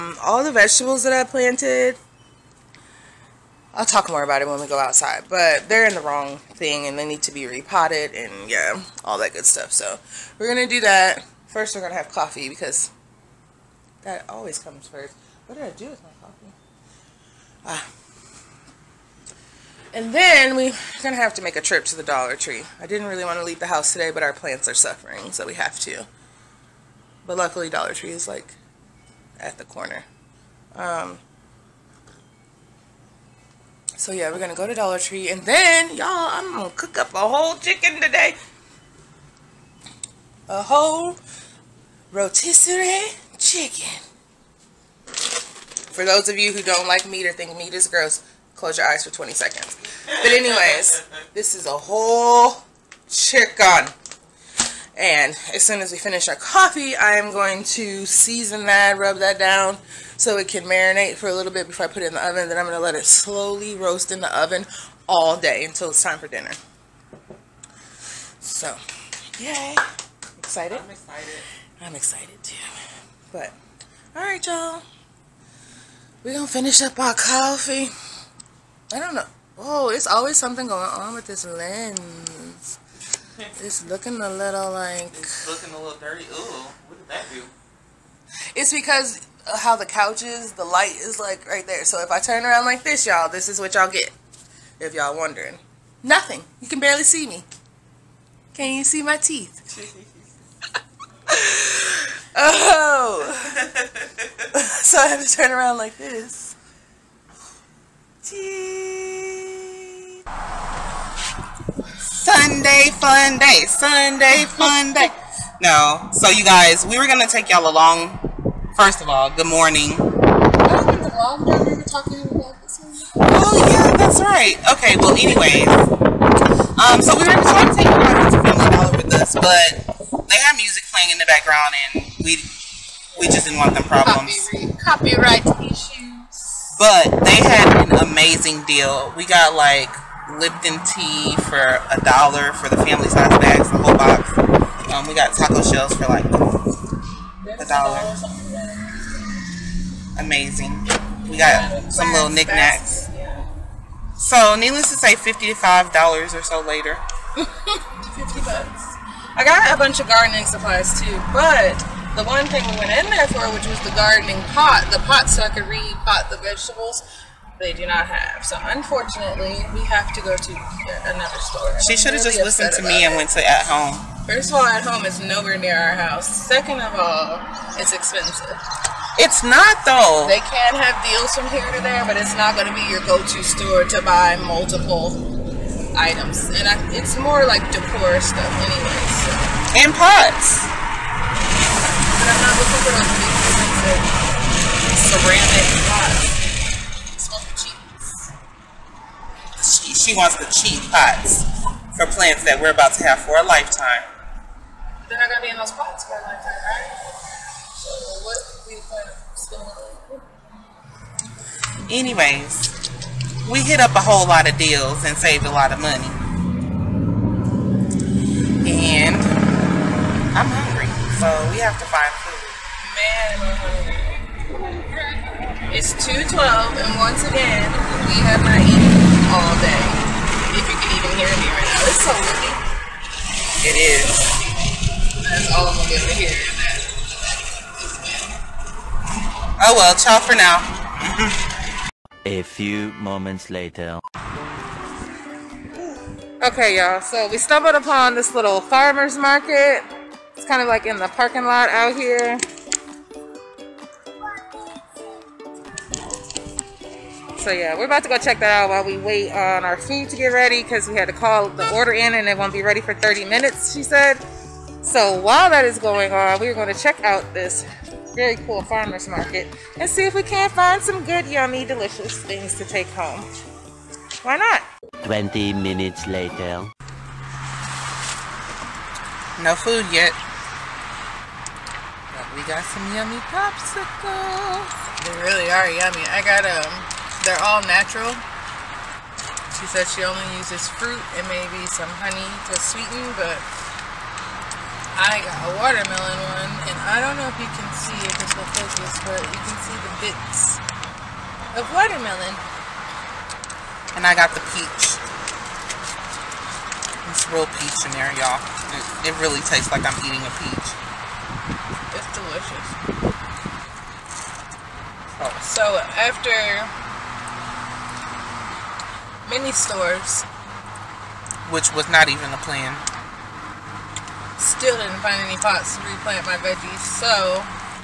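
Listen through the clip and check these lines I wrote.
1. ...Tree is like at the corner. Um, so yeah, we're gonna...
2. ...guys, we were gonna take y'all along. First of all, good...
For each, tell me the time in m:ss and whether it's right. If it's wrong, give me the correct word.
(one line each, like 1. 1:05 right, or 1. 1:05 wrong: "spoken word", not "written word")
1. 0:27 right
2. 1:56 right.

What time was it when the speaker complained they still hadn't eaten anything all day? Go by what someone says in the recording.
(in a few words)
2:12.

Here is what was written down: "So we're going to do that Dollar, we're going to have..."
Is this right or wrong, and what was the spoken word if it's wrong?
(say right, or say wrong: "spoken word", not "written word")
wrong: "First", not "Dollar".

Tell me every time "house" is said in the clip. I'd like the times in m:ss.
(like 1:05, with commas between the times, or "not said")
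0:23, 2:55.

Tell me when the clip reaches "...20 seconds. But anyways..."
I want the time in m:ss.
0:49.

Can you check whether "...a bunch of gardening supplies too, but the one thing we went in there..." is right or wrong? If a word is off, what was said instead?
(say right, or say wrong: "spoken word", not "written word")
right.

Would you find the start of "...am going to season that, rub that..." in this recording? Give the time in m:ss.
0:57.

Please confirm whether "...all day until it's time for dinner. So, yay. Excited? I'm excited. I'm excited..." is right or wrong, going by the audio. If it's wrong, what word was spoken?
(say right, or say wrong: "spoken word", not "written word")
right.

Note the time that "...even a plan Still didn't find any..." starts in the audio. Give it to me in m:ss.
5:22.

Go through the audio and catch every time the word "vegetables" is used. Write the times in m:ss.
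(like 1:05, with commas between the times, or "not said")
0:00, 2:46.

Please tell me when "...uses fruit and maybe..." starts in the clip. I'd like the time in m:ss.
4:50.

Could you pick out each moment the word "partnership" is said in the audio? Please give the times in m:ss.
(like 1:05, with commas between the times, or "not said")
not said.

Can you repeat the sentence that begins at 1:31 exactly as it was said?
So if I turn around like this, y'all, this is what y'all get.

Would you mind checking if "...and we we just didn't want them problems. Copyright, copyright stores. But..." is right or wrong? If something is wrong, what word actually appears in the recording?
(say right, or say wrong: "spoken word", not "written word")
wrong: "issues", not "stores".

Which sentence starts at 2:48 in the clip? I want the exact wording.
So unfortunately, we have to go to another store.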